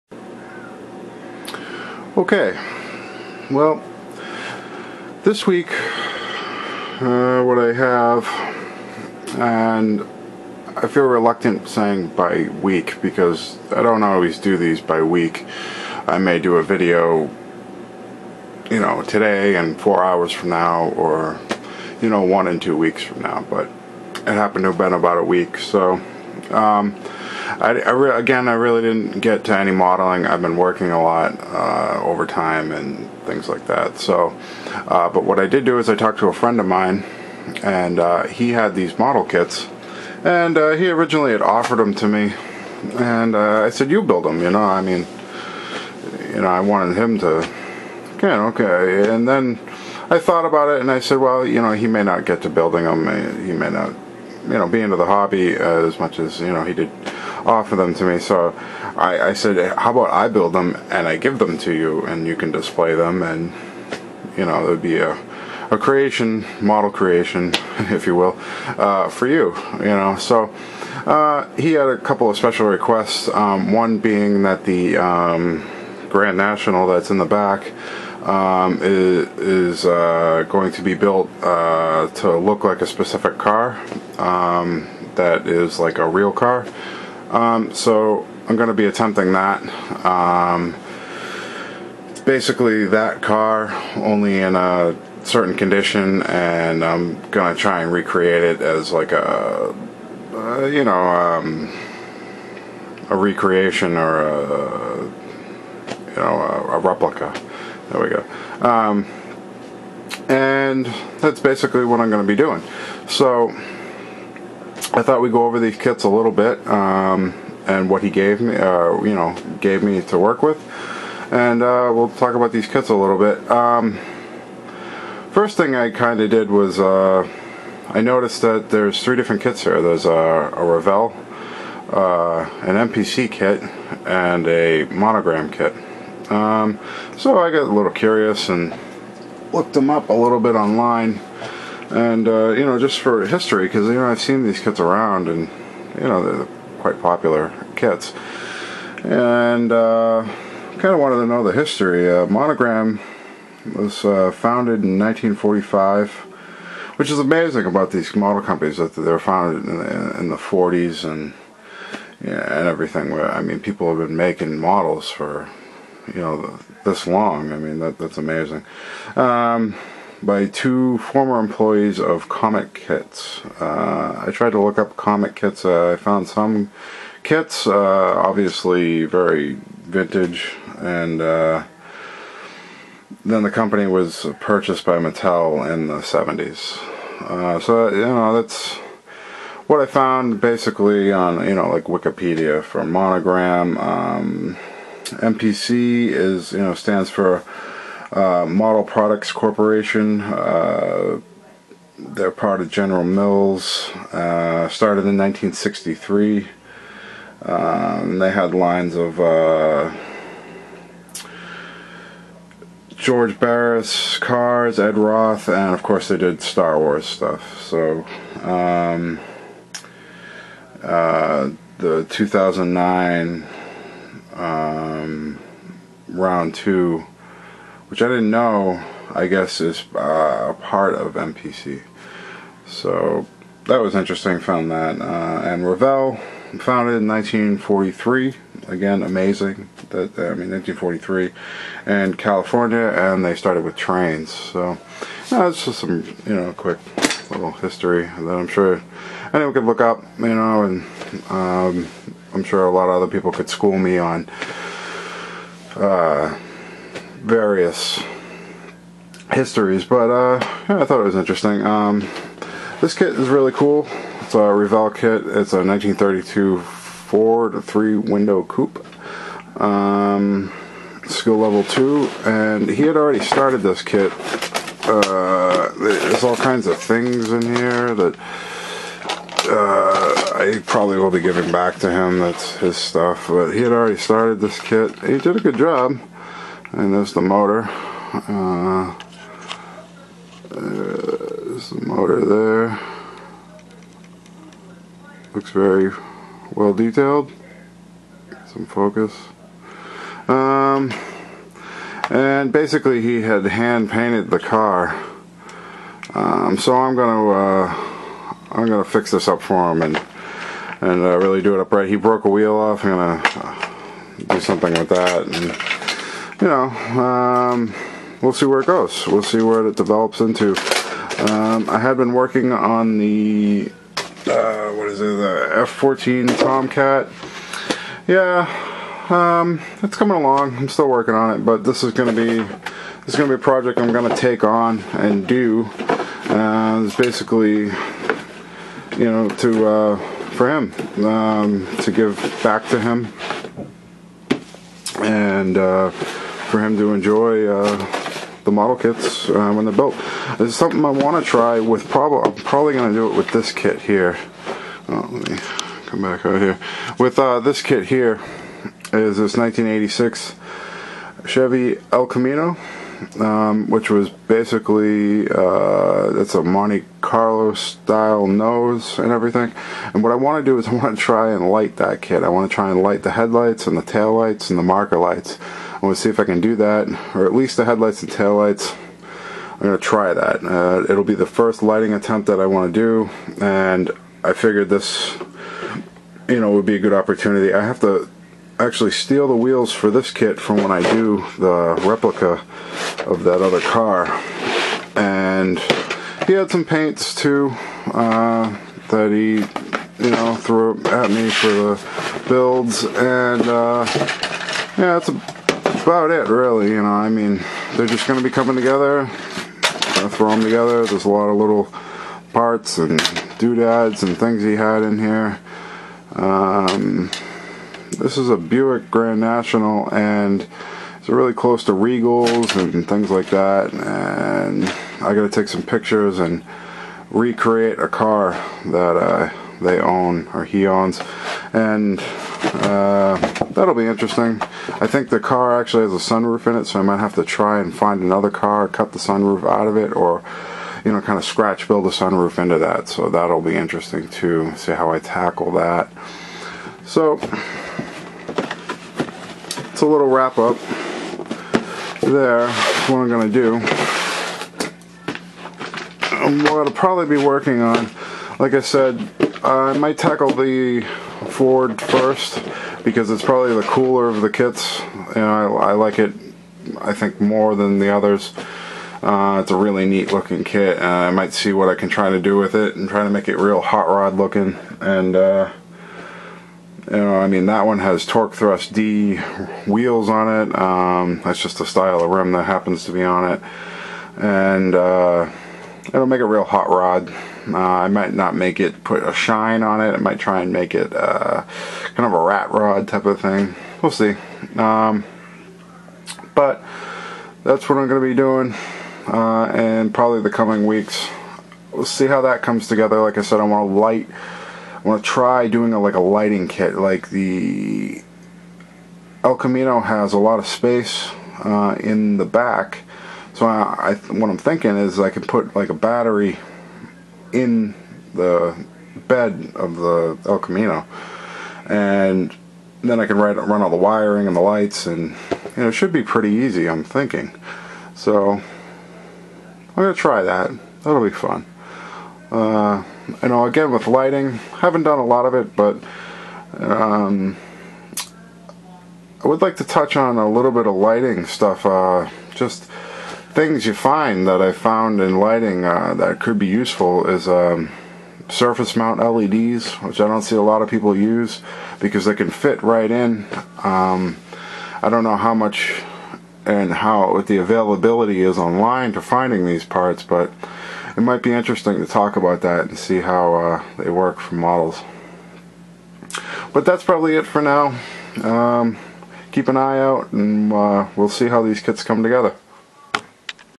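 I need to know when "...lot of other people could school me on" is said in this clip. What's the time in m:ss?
4:12.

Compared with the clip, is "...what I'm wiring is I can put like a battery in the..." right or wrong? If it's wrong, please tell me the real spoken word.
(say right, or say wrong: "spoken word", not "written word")
wrong: "thinking", not "wiring".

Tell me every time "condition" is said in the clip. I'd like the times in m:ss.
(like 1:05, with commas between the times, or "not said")
1:35.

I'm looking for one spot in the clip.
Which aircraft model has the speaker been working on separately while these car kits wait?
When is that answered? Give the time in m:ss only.
5:25.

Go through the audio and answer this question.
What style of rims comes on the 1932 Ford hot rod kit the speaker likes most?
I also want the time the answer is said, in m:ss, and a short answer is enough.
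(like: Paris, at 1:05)
Torq Thrust D, at 7:58.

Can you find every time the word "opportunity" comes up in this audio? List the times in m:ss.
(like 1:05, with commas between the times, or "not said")
6:26.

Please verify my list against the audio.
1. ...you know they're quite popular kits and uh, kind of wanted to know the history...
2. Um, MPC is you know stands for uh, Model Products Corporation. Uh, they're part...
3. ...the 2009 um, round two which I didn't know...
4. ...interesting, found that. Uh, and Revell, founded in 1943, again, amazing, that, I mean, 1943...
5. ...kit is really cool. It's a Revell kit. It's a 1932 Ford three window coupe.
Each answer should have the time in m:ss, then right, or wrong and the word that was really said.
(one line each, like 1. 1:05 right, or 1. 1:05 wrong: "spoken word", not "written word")
1. 2:25 right
2. 3:13 right
3. 3:41 right
4. 3:53 right
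5. 4:22 right.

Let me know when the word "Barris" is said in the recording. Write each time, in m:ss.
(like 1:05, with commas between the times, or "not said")
3:33.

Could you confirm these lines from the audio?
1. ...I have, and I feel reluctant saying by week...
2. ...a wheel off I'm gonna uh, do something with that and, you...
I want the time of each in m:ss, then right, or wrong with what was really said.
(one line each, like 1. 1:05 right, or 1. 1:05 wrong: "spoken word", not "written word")
1. 0:07 right
2. 5:12 right.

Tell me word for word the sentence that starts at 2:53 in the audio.
Uh, I tried to look up Comet Kits.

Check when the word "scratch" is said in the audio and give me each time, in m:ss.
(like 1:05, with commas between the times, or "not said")
7:21.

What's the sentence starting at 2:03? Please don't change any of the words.
Um, first thing I kind of did was uh, I noticed that there's three different kits here.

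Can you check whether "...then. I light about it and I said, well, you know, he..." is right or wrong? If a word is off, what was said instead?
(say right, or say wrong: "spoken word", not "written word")
wrong: "thought", not "light".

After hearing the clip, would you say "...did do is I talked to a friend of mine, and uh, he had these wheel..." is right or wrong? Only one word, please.
wrong.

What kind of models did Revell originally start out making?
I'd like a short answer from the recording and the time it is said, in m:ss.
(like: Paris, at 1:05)
Trains, at 4:03.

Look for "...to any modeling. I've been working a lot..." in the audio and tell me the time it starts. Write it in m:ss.
0:29.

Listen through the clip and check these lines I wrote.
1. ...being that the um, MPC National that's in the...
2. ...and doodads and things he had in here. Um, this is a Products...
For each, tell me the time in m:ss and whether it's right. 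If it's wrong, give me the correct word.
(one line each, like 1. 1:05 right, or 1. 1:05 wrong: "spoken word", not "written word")
1. 1:13 wrong: "Grand", not "MPC"
2. 6:52 wrong: "Buick", not "Products".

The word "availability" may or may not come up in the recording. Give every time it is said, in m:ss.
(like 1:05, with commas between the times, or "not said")
9:17.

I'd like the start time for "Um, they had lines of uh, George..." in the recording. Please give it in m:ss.
3:27.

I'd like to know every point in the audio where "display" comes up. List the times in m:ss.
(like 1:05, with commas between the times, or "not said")
1:02.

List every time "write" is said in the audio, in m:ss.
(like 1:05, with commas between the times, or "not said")
8:43.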